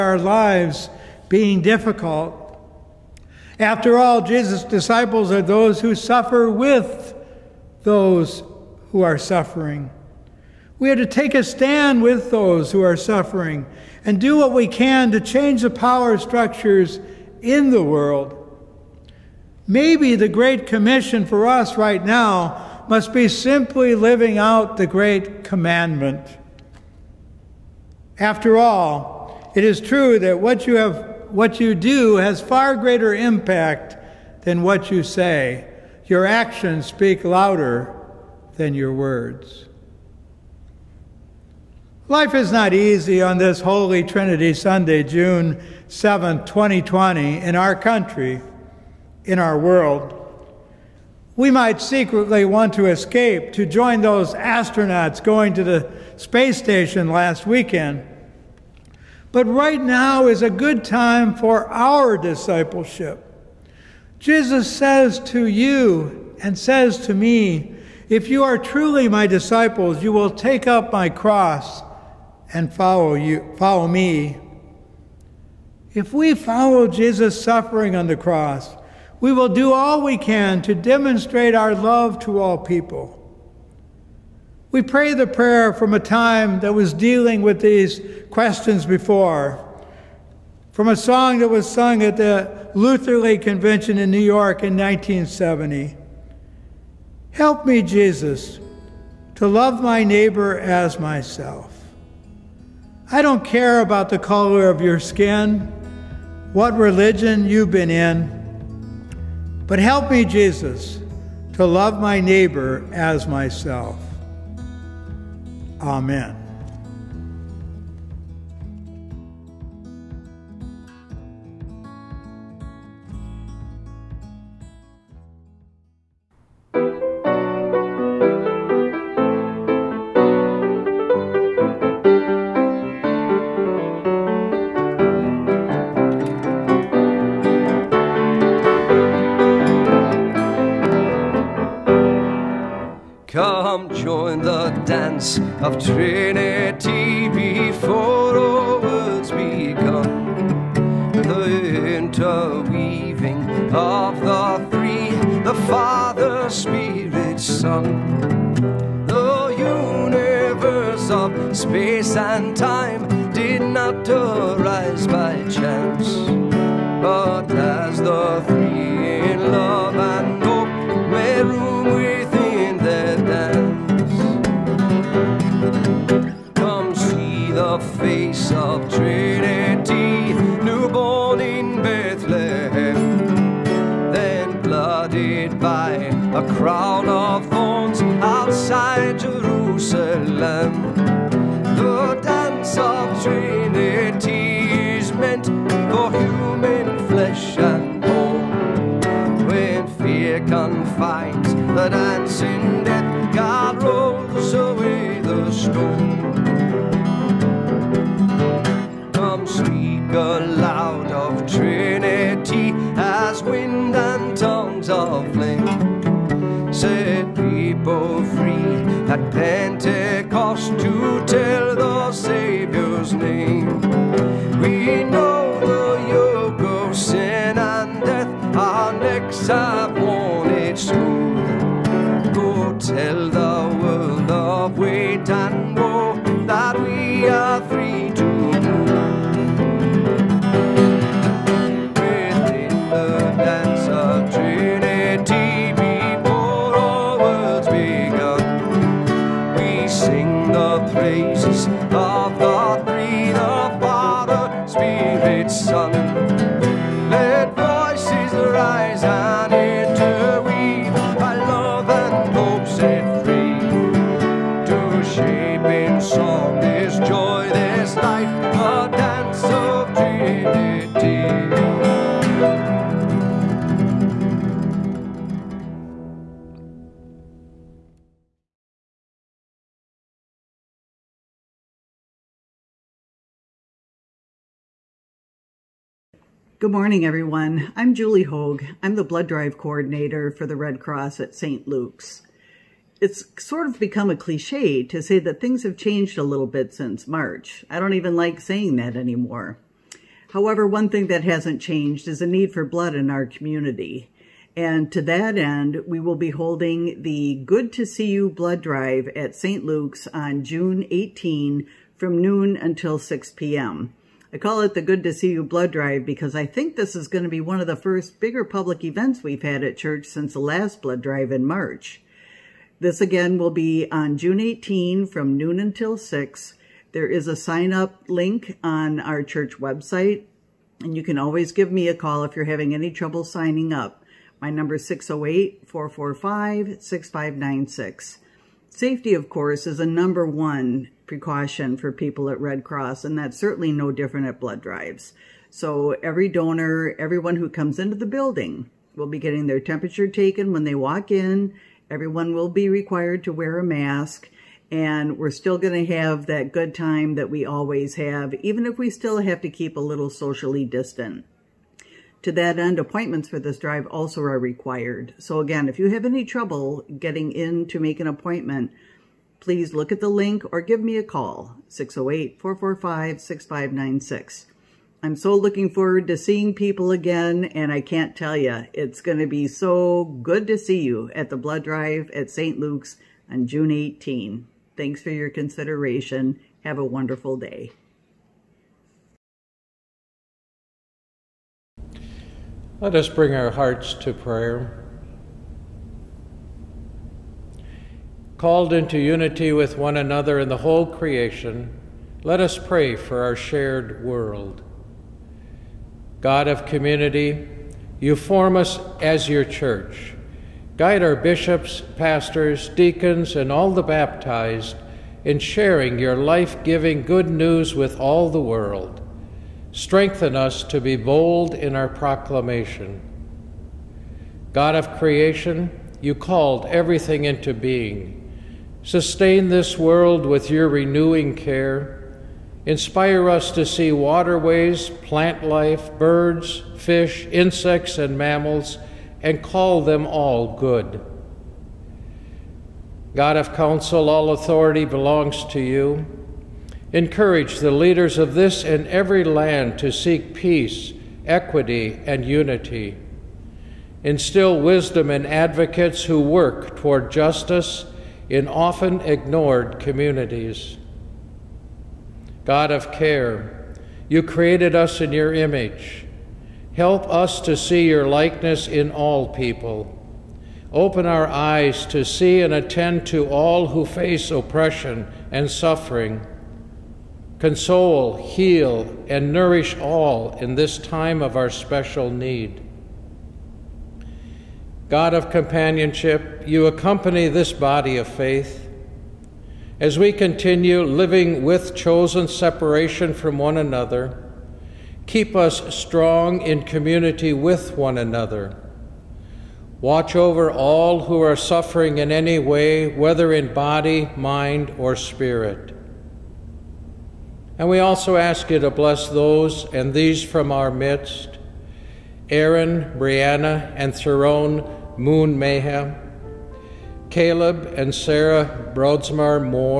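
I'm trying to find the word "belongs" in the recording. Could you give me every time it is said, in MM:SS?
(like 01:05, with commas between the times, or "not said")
07:24.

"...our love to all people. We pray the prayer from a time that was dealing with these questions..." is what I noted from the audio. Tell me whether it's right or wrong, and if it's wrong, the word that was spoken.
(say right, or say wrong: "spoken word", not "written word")
right.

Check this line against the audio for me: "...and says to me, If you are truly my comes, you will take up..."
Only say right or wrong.
wrong.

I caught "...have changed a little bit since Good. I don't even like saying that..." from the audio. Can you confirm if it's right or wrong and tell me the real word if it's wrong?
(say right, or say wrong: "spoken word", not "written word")
wrong: "March", not "Good".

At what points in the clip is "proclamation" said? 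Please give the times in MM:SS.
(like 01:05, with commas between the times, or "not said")
07:01.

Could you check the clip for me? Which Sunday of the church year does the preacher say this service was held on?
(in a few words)
Holy Trinity Sunday.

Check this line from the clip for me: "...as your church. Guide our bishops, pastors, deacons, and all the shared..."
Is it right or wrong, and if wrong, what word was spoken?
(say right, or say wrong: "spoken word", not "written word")
wrong: "baptized", not "shared".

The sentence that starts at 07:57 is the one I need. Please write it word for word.
Console, heal, and nourish all in this time of our special need.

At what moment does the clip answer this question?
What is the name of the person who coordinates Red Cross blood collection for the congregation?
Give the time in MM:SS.
04:47.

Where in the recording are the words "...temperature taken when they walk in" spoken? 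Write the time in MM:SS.
05:49.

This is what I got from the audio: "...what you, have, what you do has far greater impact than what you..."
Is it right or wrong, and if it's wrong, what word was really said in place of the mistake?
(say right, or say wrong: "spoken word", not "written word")
right.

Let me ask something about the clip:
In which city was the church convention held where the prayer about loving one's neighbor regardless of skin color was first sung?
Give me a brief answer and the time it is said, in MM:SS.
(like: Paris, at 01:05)
New York, at 01:34.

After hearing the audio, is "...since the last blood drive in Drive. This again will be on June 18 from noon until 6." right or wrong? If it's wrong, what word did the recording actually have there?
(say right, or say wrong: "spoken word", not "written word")
wrong: "March", not "Drive".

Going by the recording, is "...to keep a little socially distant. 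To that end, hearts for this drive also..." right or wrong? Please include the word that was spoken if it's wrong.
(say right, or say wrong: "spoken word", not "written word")
wrong: "appointments", not "hearts".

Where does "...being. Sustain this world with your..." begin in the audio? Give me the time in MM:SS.
07:07.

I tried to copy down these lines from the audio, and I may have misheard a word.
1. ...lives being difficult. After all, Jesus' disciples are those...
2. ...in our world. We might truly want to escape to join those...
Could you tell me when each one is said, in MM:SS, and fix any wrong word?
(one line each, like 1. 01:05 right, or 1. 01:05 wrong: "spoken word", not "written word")
1. 00:00 right
2. 00:49 wrong: "secretly", not "truly".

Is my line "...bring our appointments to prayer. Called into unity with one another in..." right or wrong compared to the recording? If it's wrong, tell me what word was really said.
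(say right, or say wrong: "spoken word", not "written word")
wrong: "hearts", not "appointments".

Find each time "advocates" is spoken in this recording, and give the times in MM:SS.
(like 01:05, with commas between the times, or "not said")
07:35.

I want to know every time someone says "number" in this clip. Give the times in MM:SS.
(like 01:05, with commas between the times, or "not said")
05:34, 05:39.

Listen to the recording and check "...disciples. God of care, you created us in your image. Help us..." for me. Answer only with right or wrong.
wrong.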